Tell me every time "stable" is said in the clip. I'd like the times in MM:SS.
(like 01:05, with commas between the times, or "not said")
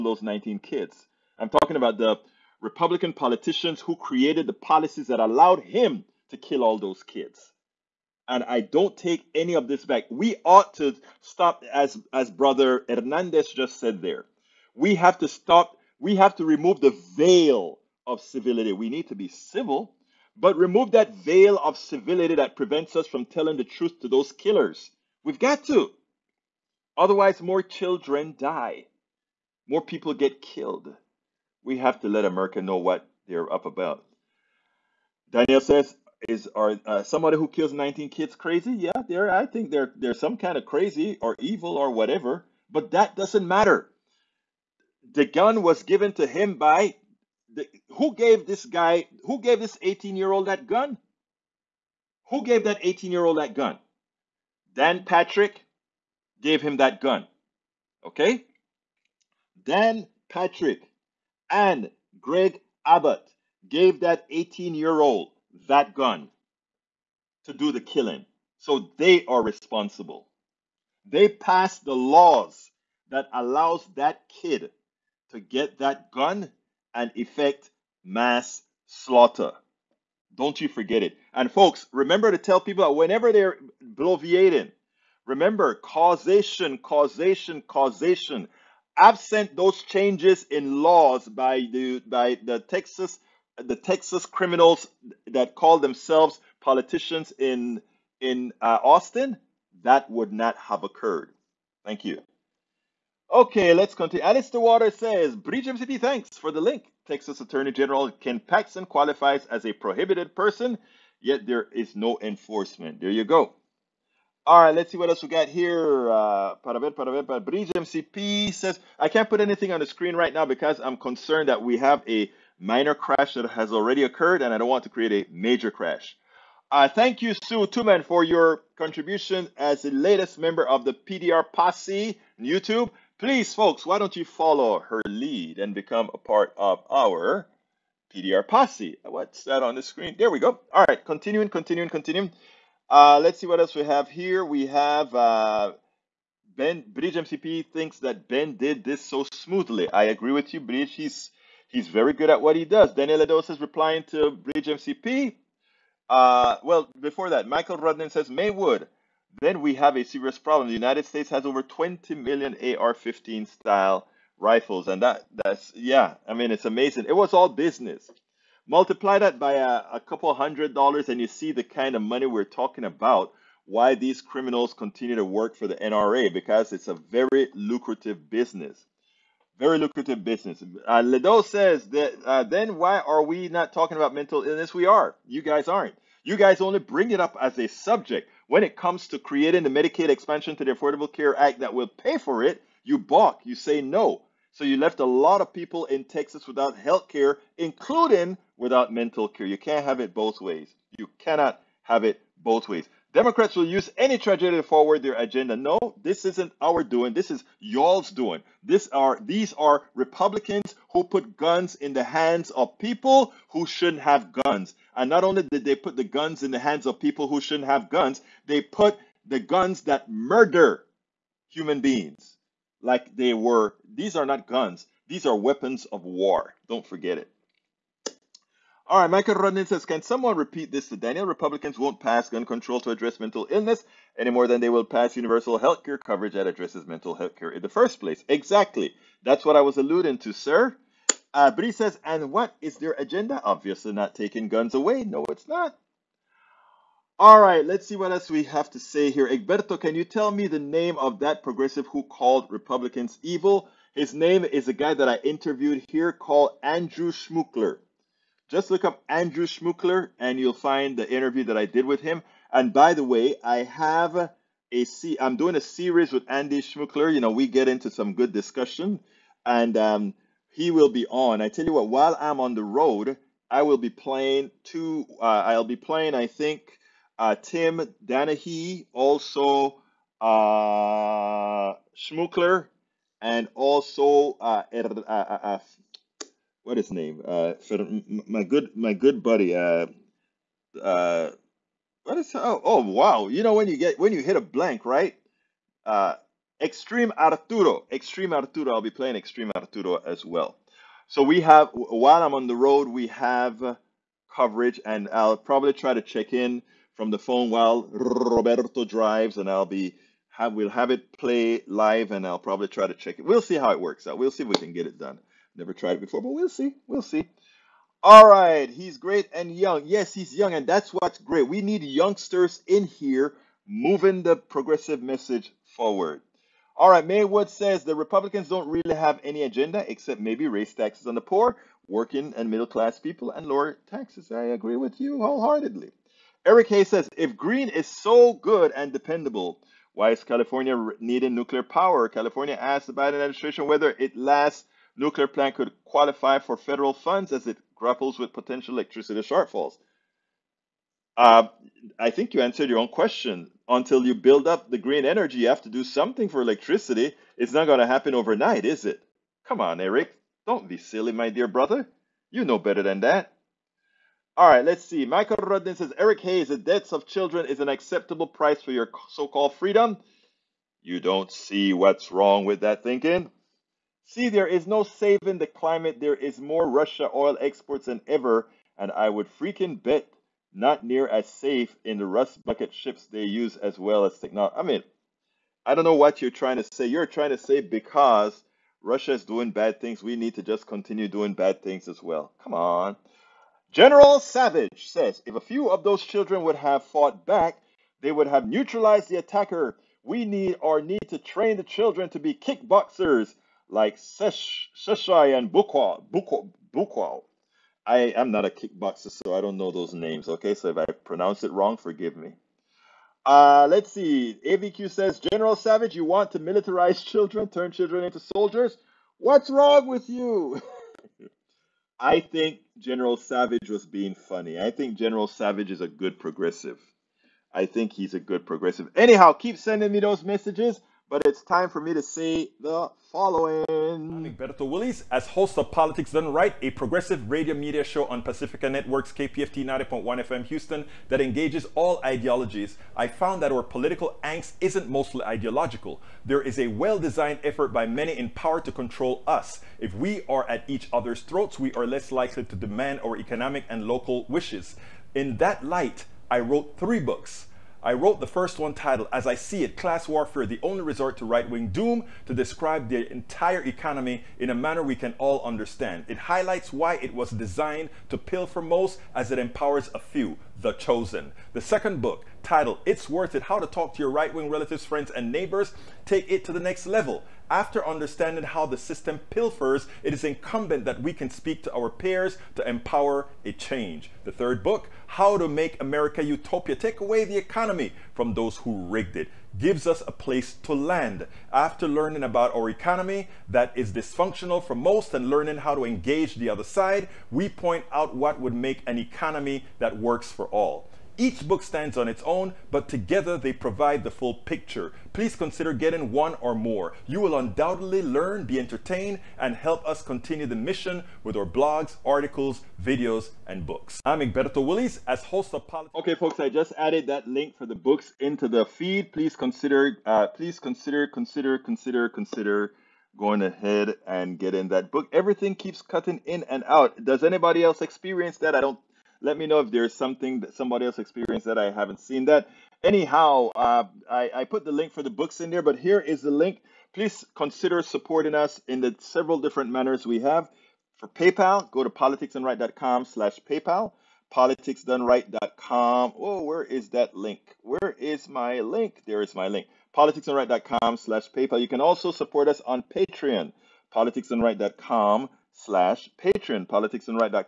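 not said.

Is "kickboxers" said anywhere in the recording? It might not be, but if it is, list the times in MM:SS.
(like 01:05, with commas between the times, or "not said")
06:42, 06:48.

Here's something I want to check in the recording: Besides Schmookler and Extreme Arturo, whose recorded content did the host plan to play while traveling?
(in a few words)
Tim Danahy.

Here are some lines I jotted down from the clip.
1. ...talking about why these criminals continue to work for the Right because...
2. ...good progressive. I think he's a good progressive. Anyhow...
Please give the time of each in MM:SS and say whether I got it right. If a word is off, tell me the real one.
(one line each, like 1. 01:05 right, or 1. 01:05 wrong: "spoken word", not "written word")
1. 02:52 wrong: "NRA", not "Right"
2. 07:05 right.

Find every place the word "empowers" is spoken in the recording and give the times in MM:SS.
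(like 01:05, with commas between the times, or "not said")
07:49, 08:02.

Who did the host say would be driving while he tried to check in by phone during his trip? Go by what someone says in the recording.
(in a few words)
Roberto.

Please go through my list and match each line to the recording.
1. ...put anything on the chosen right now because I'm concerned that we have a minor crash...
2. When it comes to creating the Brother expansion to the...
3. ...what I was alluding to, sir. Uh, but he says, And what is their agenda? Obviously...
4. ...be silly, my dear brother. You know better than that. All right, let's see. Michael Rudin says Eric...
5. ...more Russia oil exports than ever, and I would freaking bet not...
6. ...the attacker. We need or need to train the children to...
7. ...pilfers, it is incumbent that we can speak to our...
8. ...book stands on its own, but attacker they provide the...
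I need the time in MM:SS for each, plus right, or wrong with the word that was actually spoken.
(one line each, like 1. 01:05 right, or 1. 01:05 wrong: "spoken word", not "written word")
1. 01:59 wrong: "screen", not "chosen"
2. 03:08 wrong: "Medicaid", not "Brother"
3. 03:59 right
4. 06:00 right
5. 06:16 right
6. 06:39 right
7. 07:59 right
8. 08:21 wrong: "together", not "attacker".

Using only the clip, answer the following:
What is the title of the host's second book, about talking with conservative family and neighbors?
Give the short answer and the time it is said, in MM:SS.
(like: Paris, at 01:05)
It's Worth It, at 07:52.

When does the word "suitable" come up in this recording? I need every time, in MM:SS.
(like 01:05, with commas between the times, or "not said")
not said.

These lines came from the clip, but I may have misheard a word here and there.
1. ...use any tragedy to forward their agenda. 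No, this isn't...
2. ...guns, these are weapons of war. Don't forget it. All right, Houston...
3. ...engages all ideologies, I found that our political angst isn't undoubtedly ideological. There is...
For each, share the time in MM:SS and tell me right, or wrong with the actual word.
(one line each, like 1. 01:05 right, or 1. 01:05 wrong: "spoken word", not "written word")
1. 03:23 right
2. 03:44 wrong: "Michael", not "Houston"
3. 07:21 wrong: "mostly", not "undoubtedly".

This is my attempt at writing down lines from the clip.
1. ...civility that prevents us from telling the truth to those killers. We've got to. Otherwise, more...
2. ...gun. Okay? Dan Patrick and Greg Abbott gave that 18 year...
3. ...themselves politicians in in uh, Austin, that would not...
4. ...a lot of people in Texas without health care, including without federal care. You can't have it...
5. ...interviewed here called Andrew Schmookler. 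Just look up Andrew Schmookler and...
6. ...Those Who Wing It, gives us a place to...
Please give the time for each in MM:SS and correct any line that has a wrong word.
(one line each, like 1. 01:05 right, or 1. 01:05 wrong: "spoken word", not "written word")
1. 00:21 right
2. 00:56 right
3. 01:35 right
4. 03:14 wrong: "mental", not "federal"
5. 04:15 right
6. 08:08 wrong: "Rigged", not "Wing".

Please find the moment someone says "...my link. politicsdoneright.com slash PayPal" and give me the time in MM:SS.
09:09.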